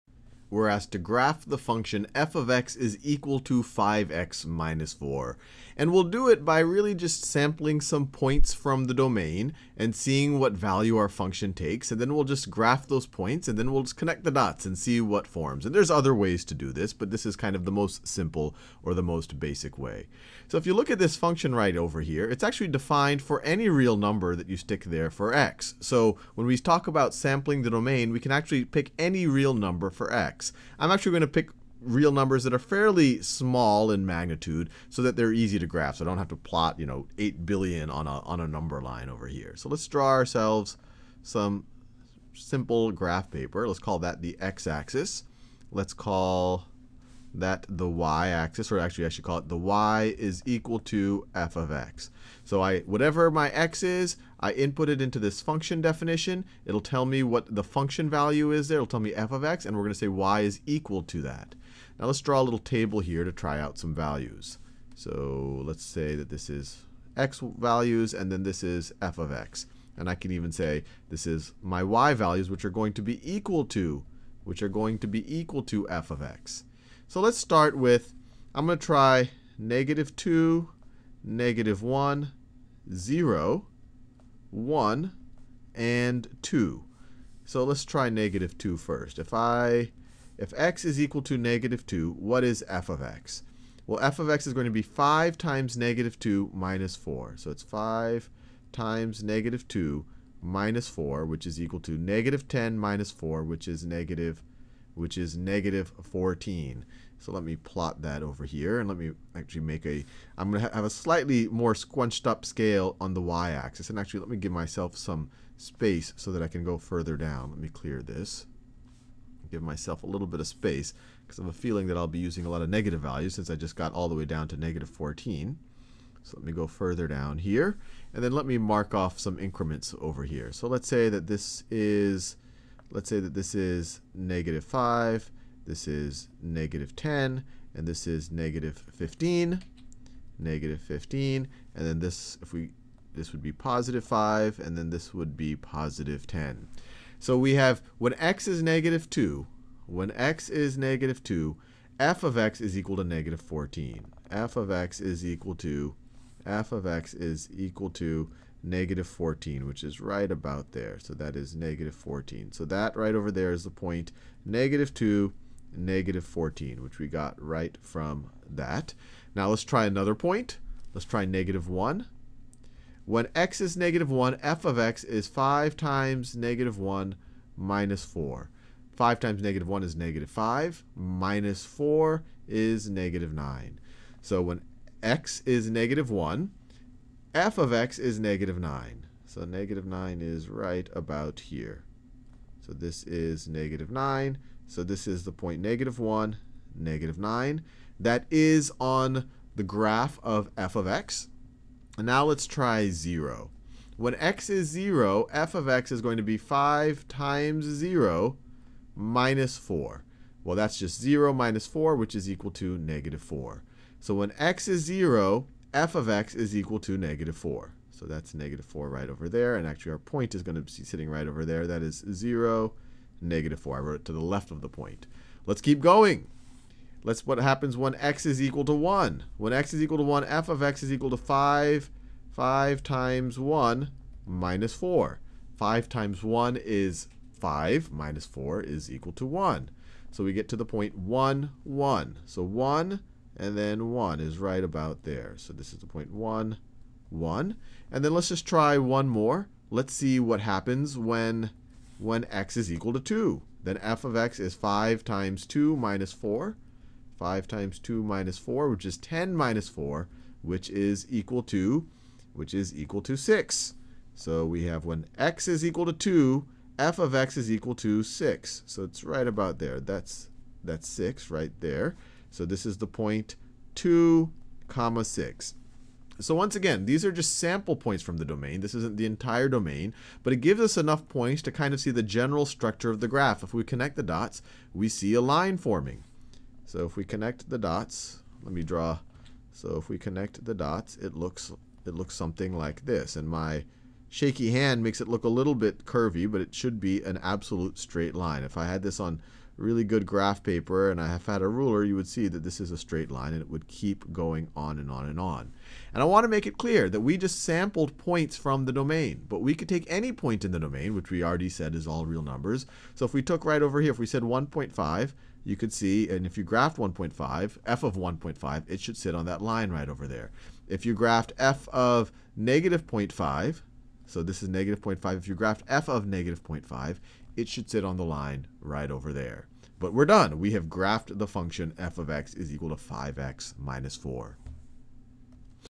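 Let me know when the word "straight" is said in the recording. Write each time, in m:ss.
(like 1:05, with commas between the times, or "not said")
4:57, 5:02.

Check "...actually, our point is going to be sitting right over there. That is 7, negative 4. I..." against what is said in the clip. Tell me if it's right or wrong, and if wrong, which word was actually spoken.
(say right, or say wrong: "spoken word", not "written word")
wrong: "0", not "7".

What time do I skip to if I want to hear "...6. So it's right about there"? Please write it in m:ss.
4:28.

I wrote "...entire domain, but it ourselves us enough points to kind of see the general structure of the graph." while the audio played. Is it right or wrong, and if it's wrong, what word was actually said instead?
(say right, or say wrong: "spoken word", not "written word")
wrong: "gives", not "ourselves".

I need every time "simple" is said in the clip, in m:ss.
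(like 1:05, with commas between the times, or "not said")
0:18, 0:42.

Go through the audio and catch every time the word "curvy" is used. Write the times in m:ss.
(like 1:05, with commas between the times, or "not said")
4:55.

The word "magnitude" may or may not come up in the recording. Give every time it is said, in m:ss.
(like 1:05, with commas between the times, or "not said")
0:34.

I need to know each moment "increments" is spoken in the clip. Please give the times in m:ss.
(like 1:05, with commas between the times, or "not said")
2:09.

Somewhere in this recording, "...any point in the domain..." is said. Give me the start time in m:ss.
5:09.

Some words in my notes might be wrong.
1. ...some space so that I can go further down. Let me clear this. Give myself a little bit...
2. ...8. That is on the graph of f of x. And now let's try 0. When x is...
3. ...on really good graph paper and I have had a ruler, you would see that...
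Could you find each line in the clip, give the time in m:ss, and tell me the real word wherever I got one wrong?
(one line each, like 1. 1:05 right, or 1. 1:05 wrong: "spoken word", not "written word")
1. 1:54 right
2. 3:17 wrong: "9", not "8"
3. 4:58 right.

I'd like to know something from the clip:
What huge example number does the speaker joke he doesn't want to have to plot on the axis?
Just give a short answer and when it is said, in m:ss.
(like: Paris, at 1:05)
8 billion, at 0:37.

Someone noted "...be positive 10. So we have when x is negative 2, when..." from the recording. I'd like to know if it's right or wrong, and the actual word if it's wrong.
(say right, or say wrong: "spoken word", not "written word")
right.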